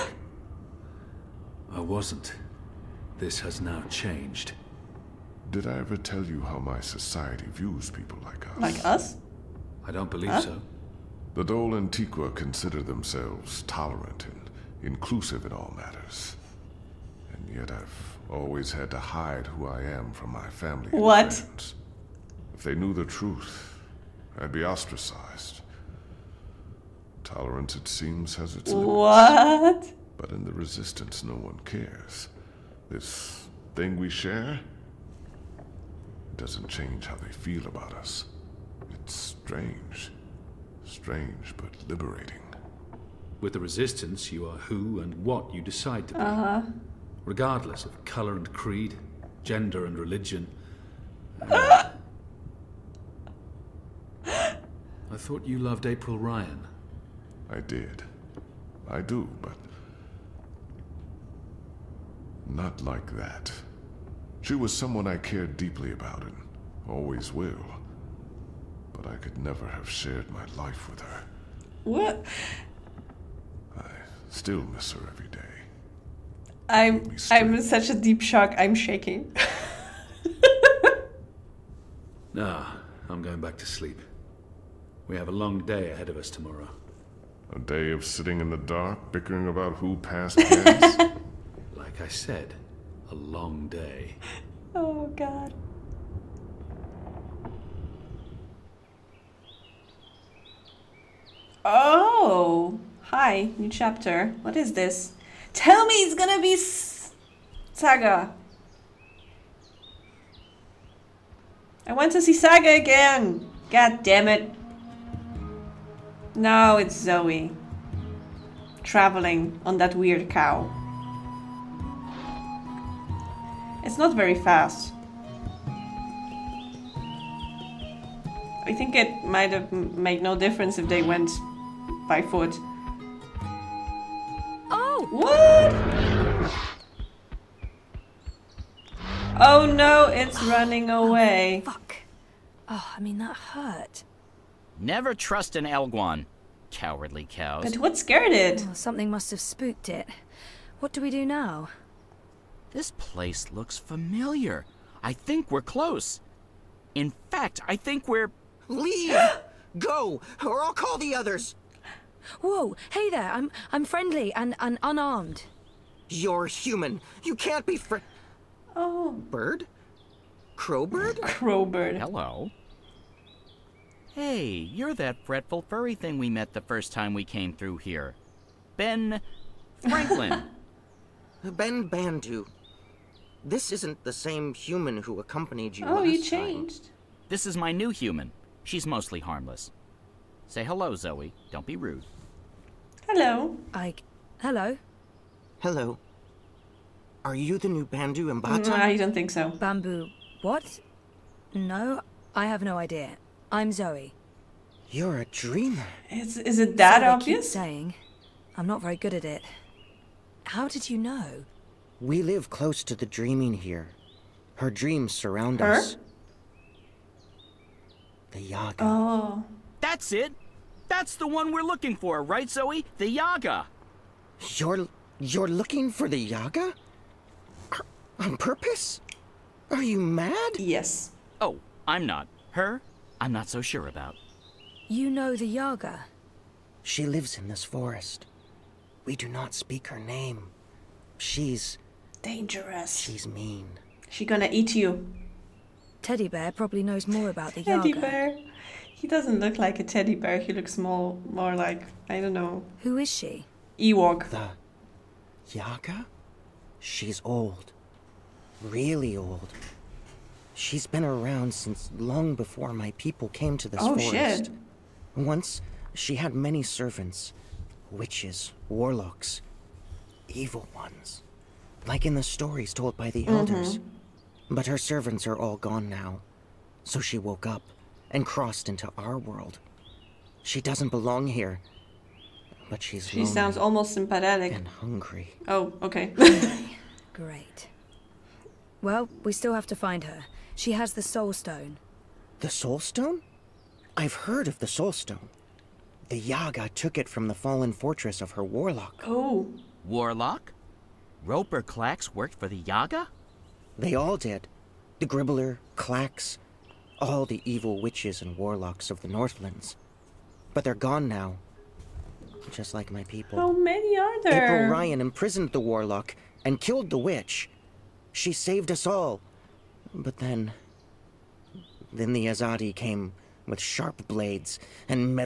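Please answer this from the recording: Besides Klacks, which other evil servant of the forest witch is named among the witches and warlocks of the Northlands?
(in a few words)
The Gribbler.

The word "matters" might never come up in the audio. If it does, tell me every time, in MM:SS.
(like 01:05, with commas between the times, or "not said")
00:15.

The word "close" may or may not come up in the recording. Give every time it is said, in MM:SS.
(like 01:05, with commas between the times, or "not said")
02:35, 03:32.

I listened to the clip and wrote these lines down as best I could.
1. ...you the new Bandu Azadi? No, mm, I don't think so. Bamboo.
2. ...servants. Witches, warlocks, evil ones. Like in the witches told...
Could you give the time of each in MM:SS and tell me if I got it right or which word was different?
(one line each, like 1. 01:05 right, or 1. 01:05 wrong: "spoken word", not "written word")
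1. 03:17 wrong: "Mbata", not "Azadi"
2. 04:26 wrong: "stories", not "witches".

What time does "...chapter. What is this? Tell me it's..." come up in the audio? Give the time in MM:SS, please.
01:43.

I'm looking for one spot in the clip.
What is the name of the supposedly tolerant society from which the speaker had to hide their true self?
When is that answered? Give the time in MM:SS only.
00:11.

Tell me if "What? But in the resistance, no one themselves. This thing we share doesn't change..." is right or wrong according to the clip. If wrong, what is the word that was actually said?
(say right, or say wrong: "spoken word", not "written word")
wrong: "cares", not "themselves".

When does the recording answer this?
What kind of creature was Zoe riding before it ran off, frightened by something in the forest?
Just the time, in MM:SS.
02:25.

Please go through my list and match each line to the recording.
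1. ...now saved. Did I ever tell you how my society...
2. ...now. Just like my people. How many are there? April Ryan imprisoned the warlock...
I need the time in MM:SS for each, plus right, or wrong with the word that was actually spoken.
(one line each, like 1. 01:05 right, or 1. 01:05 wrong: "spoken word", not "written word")
1. 00:03 wrong: "changed", not "saved"
2. 05:11 right.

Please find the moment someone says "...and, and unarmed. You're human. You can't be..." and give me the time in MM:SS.
02:44.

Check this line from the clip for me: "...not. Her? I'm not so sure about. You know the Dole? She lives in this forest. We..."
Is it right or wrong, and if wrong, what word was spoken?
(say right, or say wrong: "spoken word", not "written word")
wrong: "Yaga", not "Dole".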